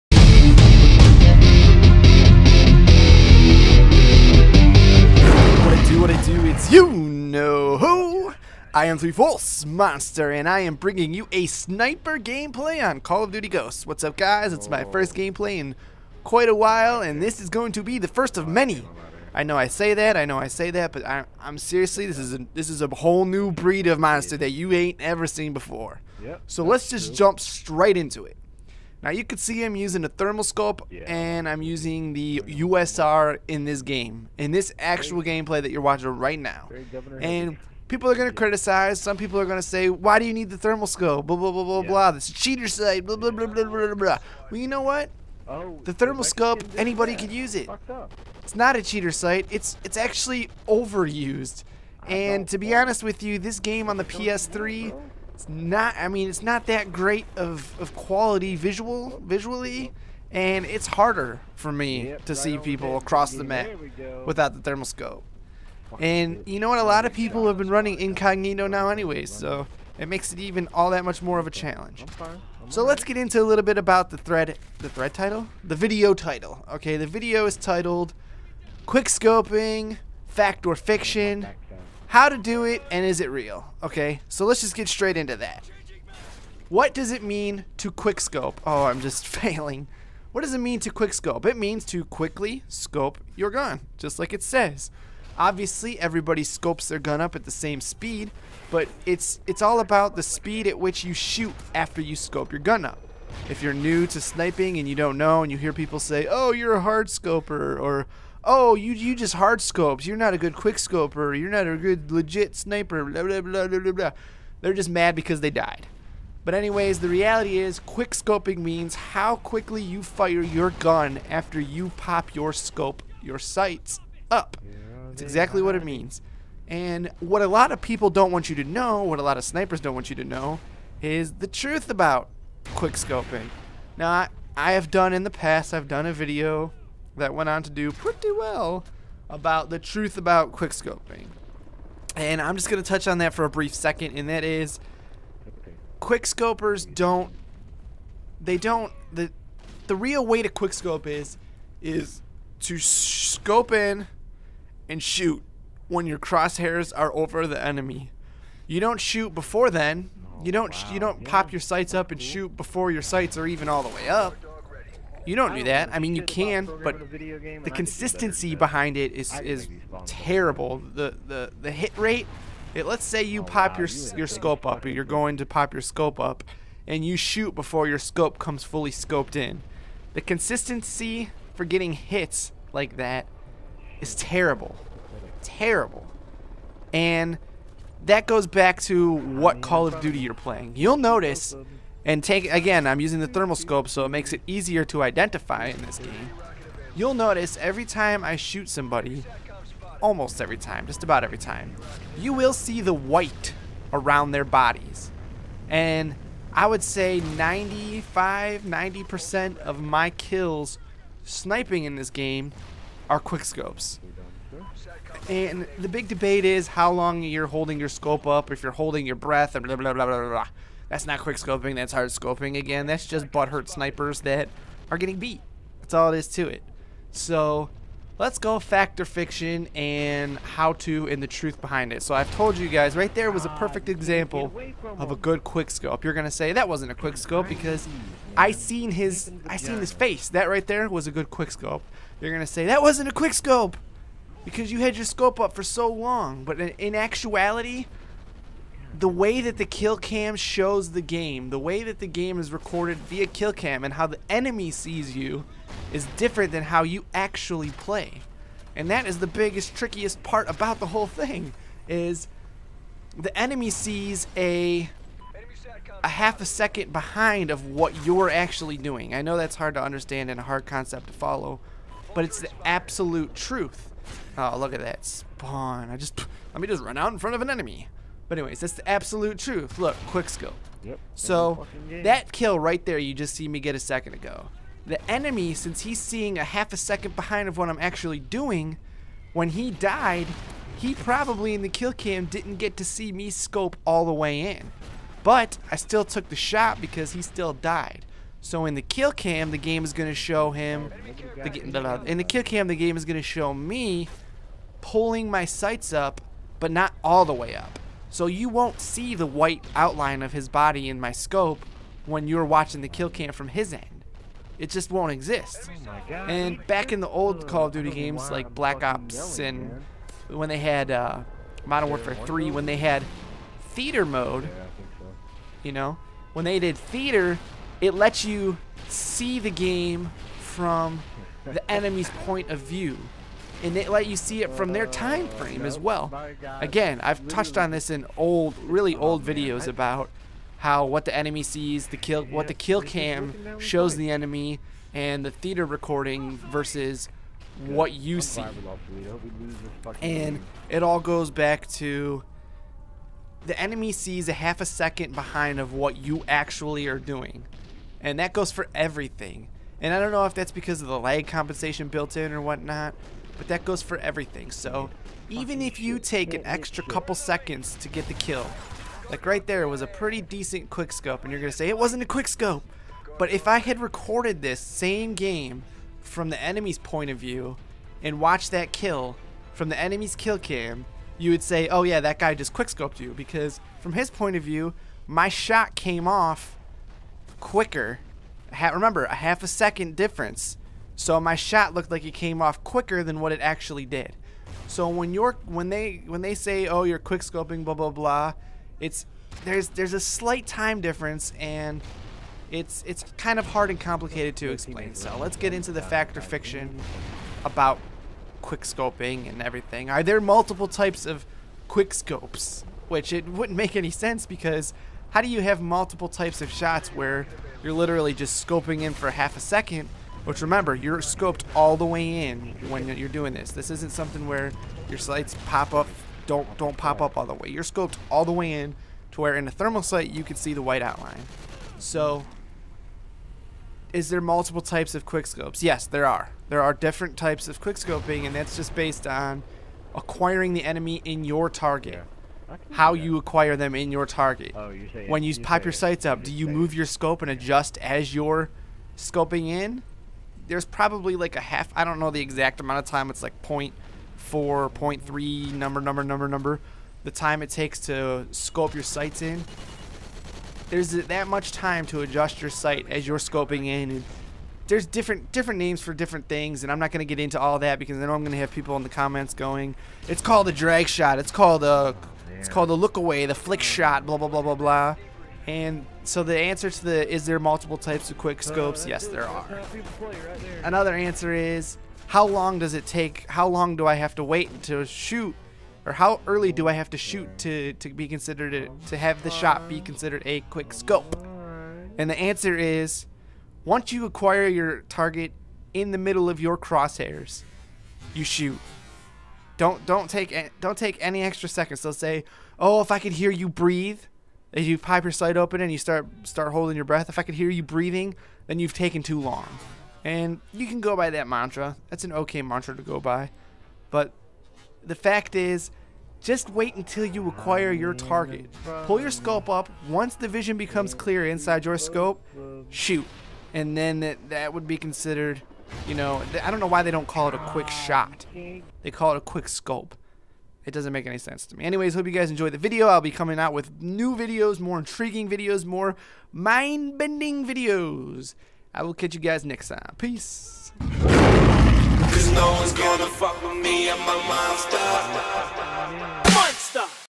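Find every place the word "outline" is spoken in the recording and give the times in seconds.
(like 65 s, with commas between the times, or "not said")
309 s, 430 s.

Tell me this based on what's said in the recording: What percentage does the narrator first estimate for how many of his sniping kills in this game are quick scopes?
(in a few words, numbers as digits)
95%.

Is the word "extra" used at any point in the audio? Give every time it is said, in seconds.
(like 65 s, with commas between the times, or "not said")
366 s, 501 s.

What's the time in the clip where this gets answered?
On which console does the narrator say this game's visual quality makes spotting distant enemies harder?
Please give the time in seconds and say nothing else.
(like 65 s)
54 s.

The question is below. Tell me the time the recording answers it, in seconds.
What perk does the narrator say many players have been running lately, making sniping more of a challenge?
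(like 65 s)
67 s.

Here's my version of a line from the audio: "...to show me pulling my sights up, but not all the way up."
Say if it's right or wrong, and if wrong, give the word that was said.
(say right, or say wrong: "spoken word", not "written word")
right.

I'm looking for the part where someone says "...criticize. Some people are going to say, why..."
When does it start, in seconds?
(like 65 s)
38 s.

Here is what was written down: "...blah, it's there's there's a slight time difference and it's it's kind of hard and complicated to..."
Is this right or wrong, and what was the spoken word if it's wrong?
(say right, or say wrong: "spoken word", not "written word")
right.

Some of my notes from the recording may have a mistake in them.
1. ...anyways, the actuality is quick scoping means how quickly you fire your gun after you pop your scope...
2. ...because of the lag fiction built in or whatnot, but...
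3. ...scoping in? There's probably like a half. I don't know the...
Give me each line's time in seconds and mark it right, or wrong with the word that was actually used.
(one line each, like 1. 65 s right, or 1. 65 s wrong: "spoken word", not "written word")
1. 116 s wrong: "reality", not "actuality"
2. 360 s wrong: "compensation", not "fiction"
3. 448 s right.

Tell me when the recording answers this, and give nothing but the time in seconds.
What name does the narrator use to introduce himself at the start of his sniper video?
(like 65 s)
8 s.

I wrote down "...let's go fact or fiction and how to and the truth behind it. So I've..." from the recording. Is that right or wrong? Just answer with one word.
right.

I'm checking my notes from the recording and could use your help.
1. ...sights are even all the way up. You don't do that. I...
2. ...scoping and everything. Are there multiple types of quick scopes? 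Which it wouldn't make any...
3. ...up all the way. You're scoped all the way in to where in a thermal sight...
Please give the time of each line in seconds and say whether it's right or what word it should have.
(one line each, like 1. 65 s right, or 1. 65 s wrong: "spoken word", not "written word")
1. 163 s right
2. 408 s right
3. 427 s right.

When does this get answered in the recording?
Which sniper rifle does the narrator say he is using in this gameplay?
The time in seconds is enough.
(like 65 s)
32 s.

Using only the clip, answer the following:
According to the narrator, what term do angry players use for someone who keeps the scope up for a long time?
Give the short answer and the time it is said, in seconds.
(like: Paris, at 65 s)
hard scoper, at 106 s.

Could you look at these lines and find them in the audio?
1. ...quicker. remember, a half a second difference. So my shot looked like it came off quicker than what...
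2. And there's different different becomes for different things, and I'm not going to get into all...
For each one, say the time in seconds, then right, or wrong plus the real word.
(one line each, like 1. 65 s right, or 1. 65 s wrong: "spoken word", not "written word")
1. 387 s right
2. 463 s wrong: "names", not "becomes".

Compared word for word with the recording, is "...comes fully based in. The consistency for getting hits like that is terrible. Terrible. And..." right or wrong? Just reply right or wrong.
wrong.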